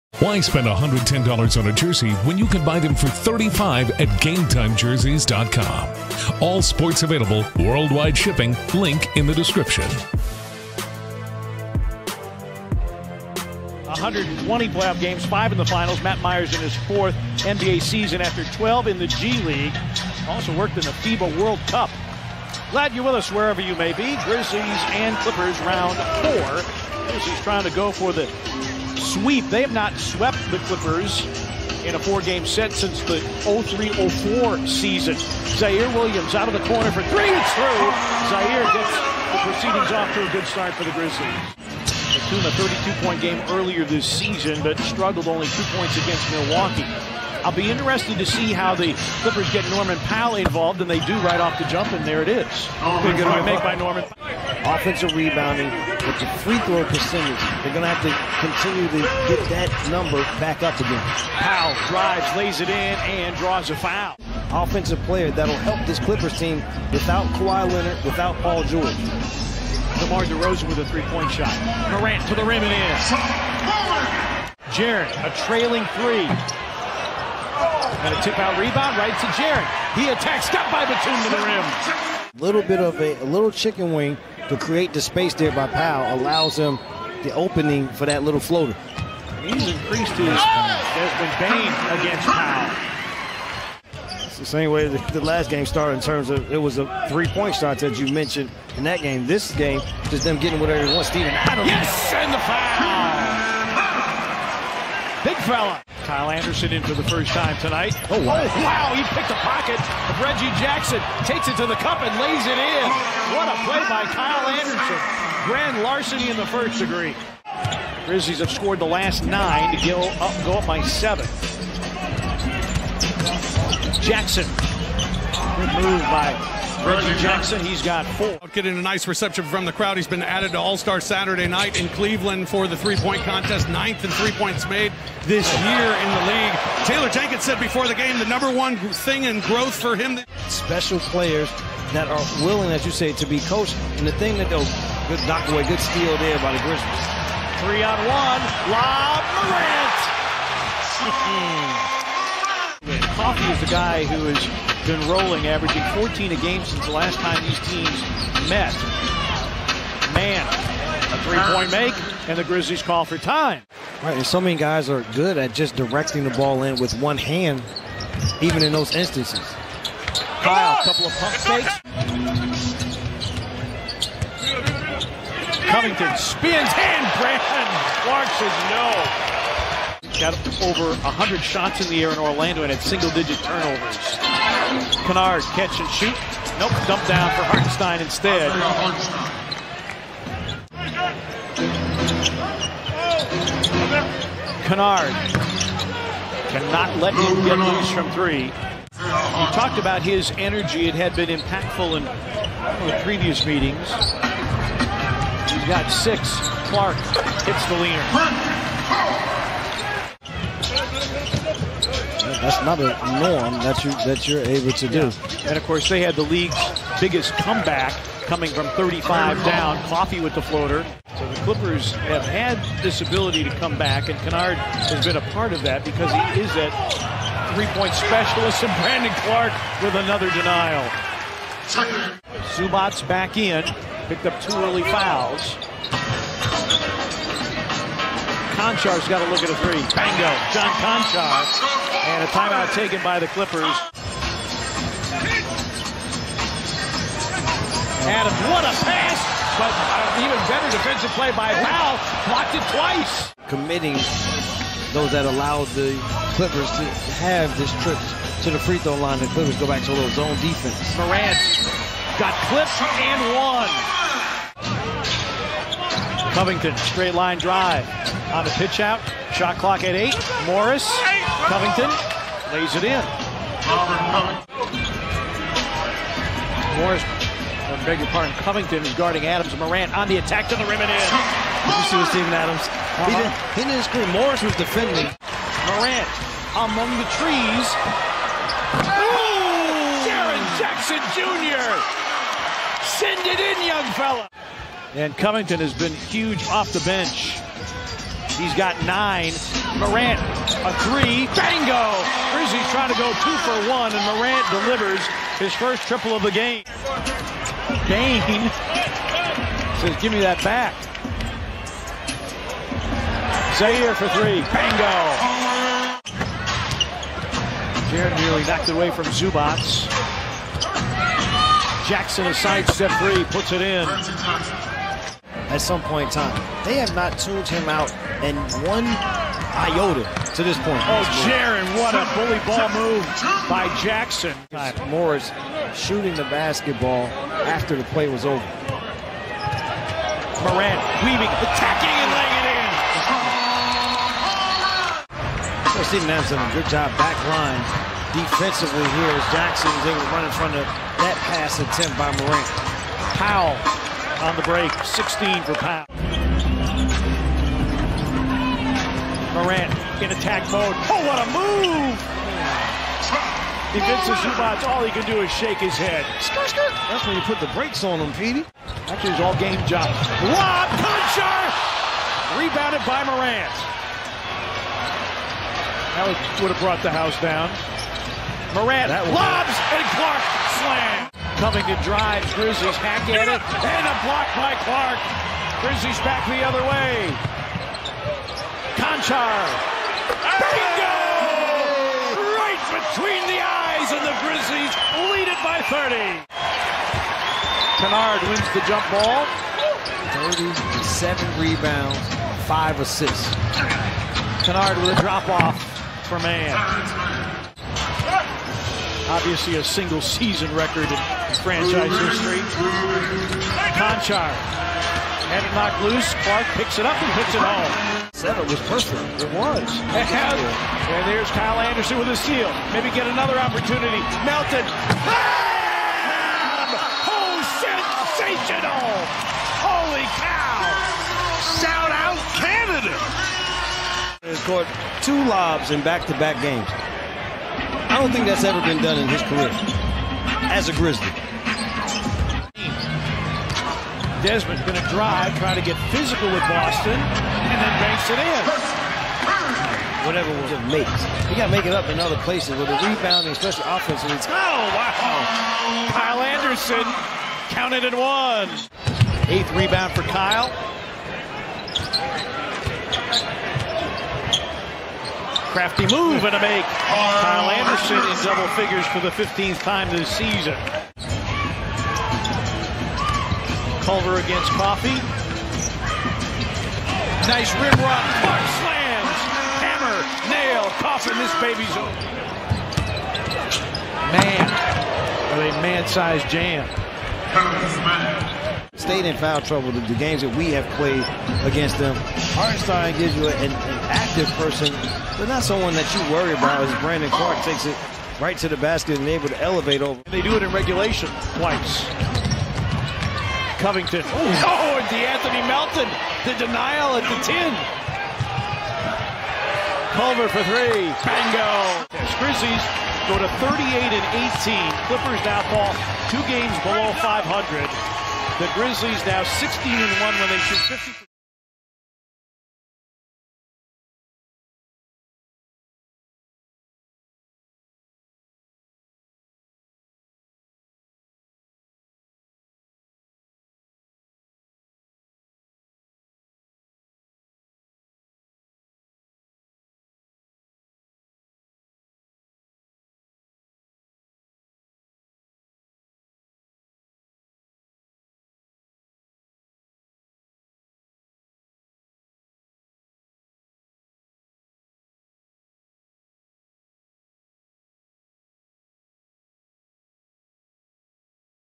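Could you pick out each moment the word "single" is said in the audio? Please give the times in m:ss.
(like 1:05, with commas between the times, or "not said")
3:02, 6:49.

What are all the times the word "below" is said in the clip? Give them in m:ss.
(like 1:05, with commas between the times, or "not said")
8:36.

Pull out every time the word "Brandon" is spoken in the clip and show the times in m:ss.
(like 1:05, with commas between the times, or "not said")
2:57, 3:48, 8:16.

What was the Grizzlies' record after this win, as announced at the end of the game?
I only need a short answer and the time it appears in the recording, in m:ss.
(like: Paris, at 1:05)
38 and 18, at 8:33.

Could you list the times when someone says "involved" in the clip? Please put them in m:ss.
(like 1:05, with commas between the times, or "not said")
0:50.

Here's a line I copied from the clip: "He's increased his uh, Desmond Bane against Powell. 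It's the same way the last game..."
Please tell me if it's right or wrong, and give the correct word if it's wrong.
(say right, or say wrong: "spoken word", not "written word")
right.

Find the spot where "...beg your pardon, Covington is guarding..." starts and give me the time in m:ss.
4:37.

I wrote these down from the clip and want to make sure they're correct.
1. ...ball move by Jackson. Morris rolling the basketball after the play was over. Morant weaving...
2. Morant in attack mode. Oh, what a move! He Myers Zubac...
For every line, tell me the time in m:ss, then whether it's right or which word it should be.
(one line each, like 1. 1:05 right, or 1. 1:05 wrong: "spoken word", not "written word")
1. 5:32 wrong: "shooting", not "rolling"
2. 5:59 wrong: "Vincent", not "Myers".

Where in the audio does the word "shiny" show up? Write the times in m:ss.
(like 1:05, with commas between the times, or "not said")
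not said.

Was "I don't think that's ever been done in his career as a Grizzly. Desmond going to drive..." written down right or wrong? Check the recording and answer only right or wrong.
right.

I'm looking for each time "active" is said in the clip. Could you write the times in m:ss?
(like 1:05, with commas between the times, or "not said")
8:13.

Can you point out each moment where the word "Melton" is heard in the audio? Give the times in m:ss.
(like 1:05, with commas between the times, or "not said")
7:04, 8:25.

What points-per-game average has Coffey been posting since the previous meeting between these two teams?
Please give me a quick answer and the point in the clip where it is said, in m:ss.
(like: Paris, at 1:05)
14, at 2:35.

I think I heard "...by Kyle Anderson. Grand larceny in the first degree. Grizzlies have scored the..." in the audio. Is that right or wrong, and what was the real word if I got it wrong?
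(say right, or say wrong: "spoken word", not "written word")
right.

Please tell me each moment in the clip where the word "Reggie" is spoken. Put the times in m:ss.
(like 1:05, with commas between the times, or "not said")
1:50, 2:06.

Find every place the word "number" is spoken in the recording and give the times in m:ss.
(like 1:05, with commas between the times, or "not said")
0:59, 2:18.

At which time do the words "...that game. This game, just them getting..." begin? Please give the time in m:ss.
1:38.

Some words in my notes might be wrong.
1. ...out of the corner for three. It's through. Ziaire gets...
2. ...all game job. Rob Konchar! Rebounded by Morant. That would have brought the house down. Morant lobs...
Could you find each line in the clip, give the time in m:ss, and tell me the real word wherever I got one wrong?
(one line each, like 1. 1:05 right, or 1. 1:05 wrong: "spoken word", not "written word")
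1. 0:36 right
2. 6:09 right.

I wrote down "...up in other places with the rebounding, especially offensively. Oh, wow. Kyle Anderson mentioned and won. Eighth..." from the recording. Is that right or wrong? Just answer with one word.
wrong.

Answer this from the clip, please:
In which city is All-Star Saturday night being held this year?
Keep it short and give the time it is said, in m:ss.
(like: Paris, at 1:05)
Cleveland, at 2:11.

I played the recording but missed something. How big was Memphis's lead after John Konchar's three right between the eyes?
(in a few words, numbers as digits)
30.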